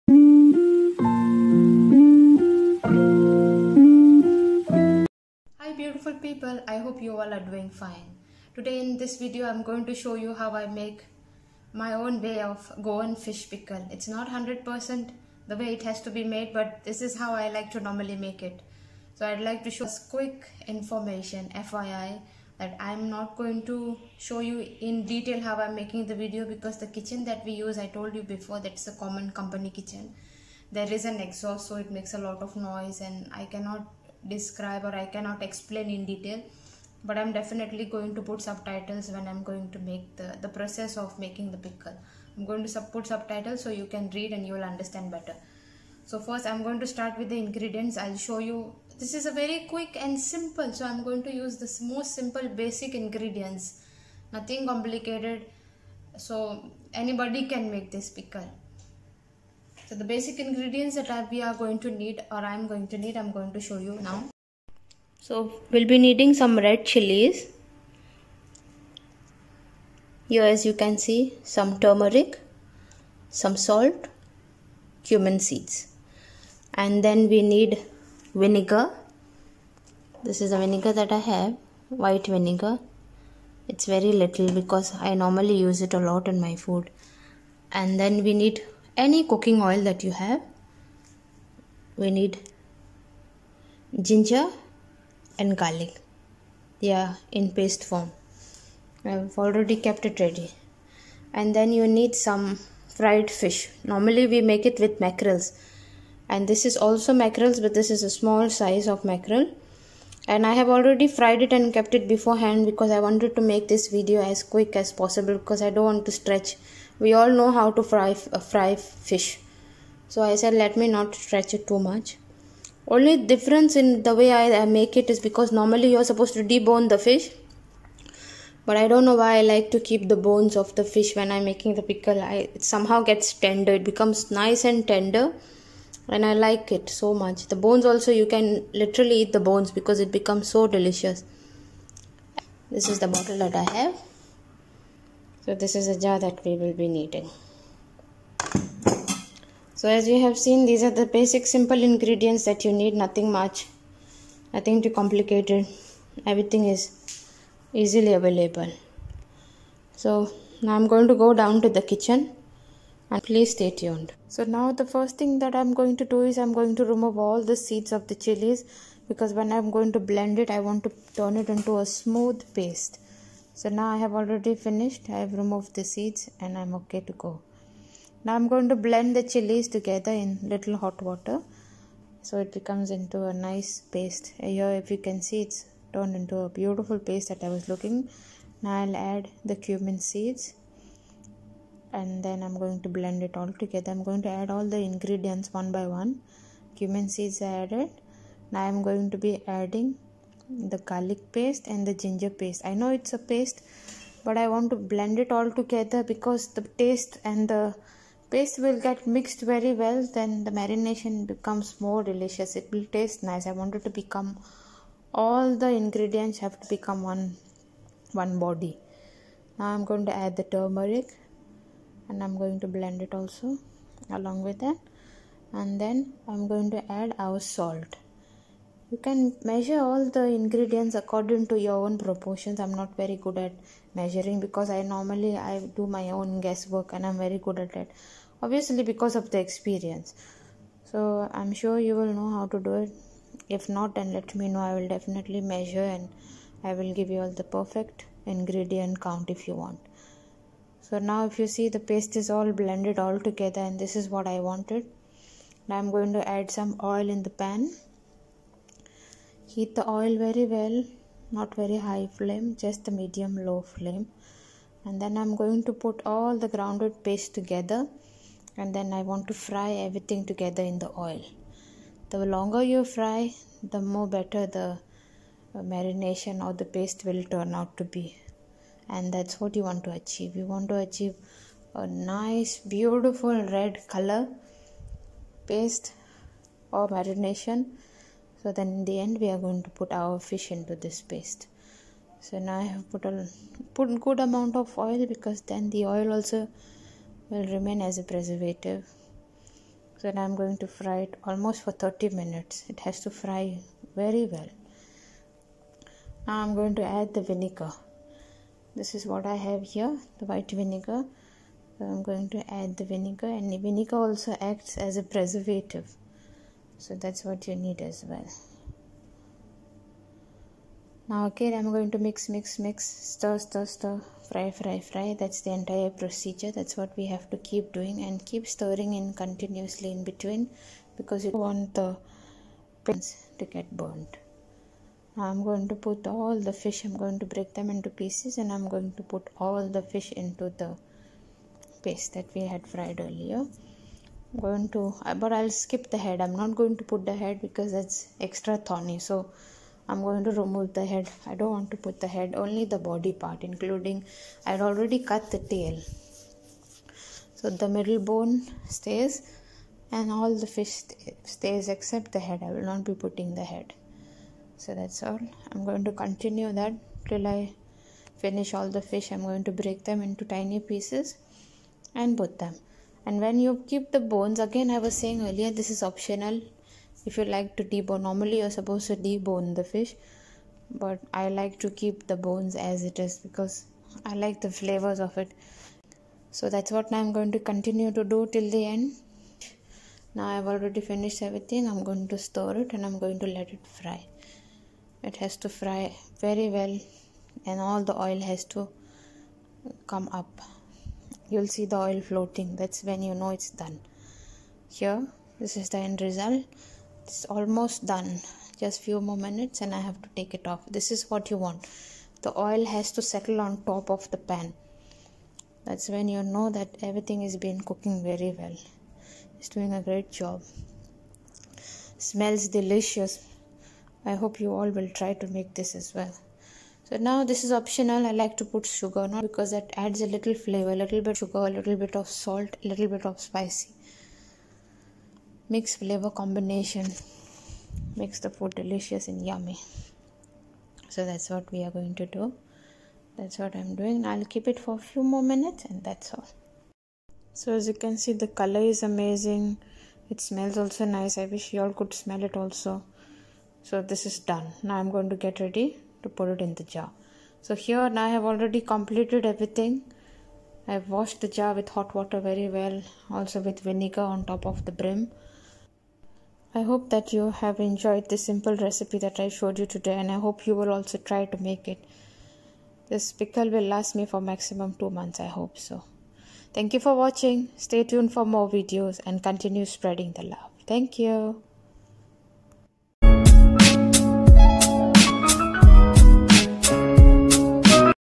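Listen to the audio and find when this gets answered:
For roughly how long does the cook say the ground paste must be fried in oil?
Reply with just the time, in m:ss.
5:01.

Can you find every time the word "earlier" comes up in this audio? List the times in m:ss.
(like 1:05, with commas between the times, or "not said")
5:43, 6:15.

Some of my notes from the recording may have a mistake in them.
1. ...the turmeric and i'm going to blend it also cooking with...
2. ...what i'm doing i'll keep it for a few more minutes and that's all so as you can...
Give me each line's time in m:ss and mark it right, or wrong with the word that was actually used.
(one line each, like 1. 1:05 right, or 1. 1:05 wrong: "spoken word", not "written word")
1. 3:40 wrong: "along", not "cooking"
2. 7:23 right.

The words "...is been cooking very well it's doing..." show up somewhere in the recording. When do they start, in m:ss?
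6:57.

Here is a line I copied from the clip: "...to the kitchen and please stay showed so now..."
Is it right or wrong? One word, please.
wrong.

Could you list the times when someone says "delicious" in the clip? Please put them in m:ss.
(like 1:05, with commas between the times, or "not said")
2:20, 3:32, 7:02, 7:18.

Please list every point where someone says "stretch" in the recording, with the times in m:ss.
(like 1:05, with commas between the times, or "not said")
1:56, 2:01.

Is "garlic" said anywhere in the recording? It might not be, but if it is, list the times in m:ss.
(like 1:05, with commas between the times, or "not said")
1:35, 3:20.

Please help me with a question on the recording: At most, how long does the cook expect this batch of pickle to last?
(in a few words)
2 months.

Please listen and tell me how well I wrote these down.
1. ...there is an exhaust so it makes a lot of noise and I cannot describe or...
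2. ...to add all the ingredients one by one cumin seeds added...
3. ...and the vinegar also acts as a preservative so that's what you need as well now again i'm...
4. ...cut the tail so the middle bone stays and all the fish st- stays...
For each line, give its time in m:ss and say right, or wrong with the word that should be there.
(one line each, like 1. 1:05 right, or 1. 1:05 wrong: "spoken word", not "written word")
1. 0:30 right
2. 3:14 right
3. 5:13 right
4. 5:55 right.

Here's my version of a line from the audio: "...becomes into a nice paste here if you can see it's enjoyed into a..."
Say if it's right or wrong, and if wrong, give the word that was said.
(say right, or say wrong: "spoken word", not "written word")
wrong: "turned", not "enjoyed".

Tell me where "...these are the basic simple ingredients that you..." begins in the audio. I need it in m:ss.
2:30.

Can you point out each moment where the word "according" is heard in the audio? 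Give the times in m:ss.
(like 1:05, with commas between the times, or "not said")
3:50.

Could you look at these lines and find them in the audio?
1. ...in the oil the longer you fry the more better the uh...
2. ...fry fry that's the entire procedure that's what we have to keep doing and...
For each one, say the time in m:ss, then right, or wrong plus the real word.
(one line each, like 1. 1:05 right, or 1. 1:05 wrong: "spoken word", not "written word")
1. 4:30 right
2. 5:24 right.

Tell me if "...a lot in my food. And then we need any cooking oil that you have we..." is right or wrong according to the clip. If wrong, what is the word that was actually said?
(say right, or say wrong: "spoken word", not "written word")
right.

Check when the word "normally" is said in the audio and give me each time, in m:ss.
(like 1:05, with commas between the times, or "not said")
0:17, 1:25, 1:43, 2:05, 3:54, 6:18.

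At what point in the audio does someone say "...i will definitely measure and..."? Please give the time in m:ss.
4:04.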